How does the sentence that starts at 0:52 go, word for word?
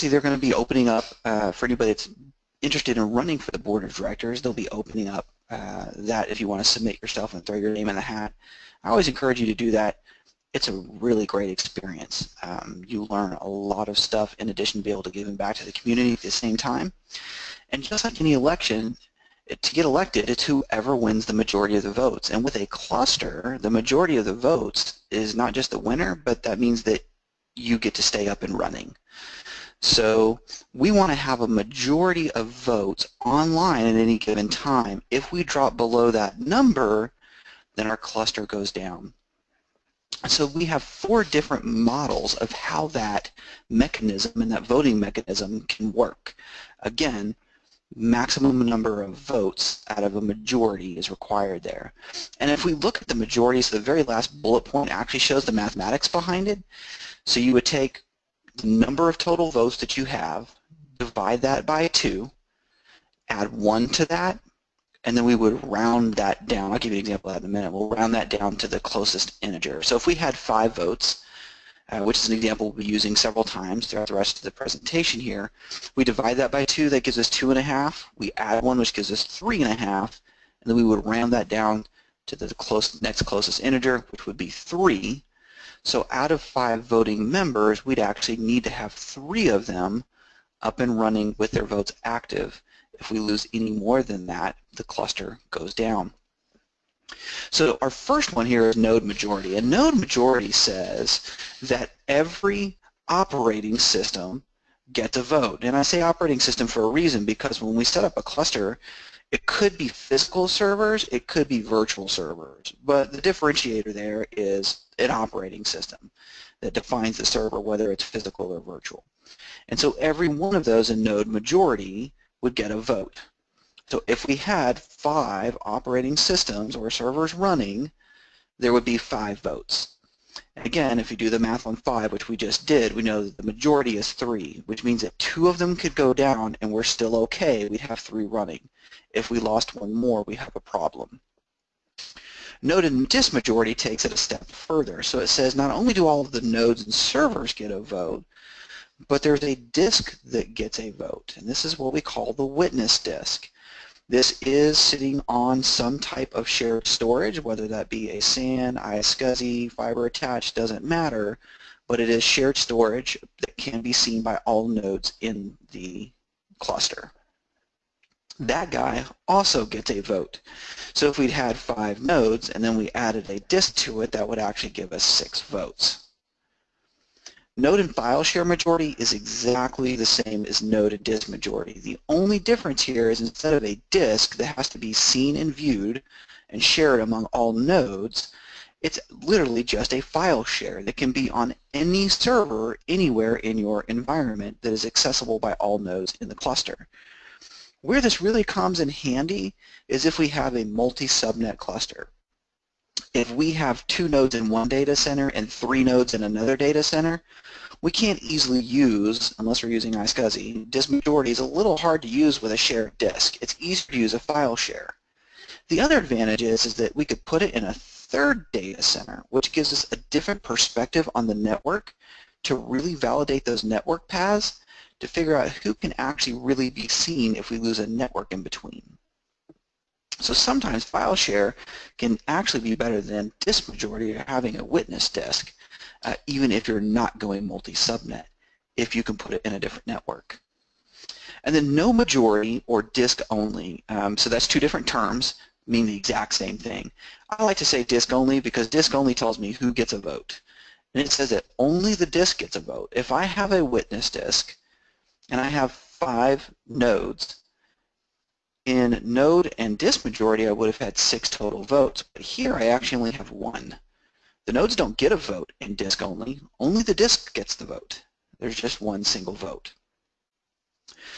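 And if we look at the majority, so the very last bullet point actually shows the mathematics behind it.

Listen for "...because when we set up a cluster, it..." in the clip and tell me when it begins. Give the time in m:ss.
1:47.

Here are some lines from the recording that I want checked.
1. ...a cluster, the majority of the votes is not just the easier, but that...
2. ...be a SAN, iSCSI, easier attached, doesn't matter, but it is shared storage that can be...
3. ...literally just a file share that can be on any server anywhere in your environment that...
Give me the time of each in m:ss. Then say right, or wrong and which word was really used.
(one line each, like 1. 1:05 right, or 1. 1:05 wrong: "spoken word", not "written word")
1. 0:22 wrong: "winner", not "easier"
2. 2:37 wrong: "fiber", not "easier"
3. 3:09 right.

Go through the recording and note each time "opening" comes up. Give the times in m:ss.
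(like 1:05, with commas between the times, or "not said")
0:00, 0:04.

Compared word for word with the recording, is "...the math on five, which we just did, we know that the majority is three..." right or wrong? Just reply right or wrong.
right.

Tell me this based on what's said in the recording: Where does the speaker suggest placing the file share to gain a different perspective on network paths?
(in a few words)
a third data center.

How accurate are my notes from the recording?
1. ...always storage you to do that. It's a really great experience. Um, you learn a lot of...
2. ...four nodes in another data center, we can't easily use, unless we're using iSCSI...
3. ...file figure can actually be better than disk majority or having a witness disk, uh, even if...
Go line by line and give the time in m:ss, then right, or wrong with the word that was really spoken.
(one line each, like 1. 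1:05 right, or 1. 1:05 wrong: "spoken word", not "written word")
1. 0:08 wrong: "encourage", not "storage"
2. 3:25 wrong: "three", not "four"
3. 3:50 wrong: "share", not "figure".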